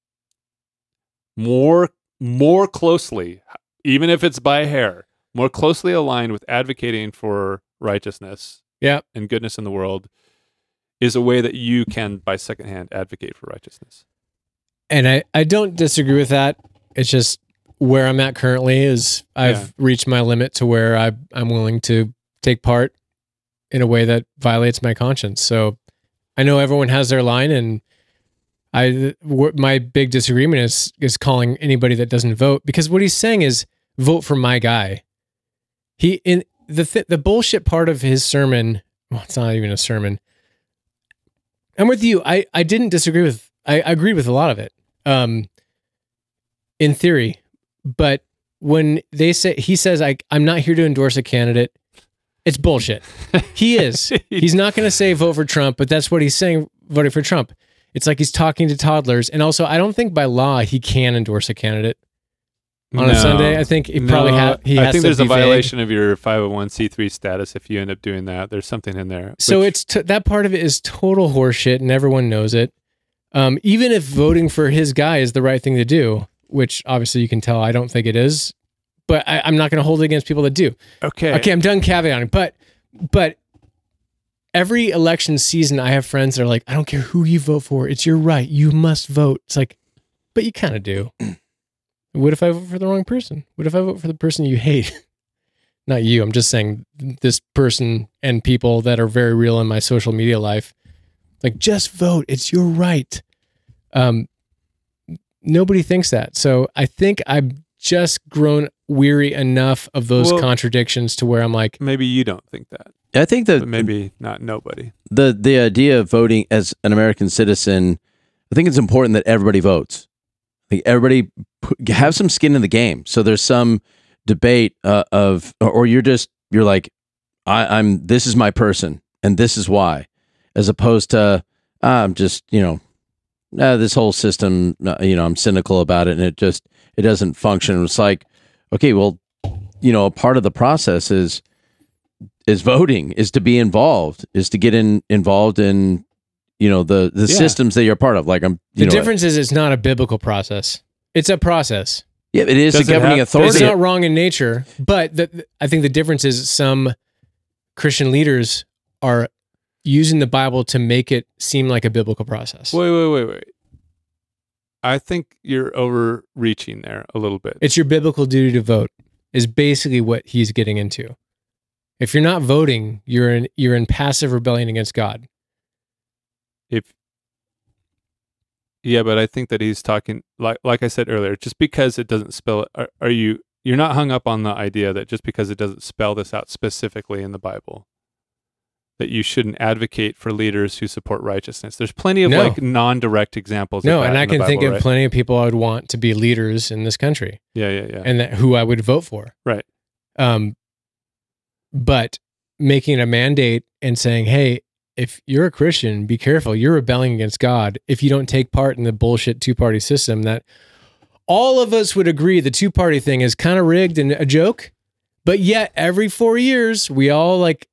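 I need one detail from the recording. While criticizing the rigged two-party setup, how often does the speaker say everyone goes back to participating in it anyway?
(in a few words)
every 4 years.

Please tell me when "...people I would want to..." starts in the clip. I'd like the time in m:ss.
3:15.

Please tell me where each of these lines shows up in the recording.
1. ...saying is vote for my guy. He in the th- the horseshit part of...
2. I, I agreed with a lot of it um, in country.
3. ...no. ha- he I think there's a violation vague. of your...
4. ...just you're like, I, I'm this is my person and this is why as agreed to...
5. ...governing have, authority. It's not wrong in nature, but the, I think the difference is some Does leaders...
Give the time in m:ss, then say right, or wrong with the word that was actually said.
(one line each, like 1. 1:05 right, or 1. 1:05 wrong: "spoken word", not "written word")
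1. 0:33 wrong: "bullshit", not "horseshit"
2. 0:43 wrong: "theory", not "country"
3. 1:04 right
4. 2:06 wrong: "opposed", not "agreed"
5. 2:32 wrong: "Christian", not "Does".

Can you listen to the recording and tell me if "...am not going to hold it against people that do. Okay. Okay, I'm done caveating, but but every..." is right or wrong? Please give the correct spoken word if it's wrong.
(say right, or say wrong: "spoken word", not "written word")
right.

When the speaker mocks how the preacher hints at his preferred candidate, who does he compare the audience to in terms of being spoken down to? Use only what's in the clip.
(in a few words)
toddlers.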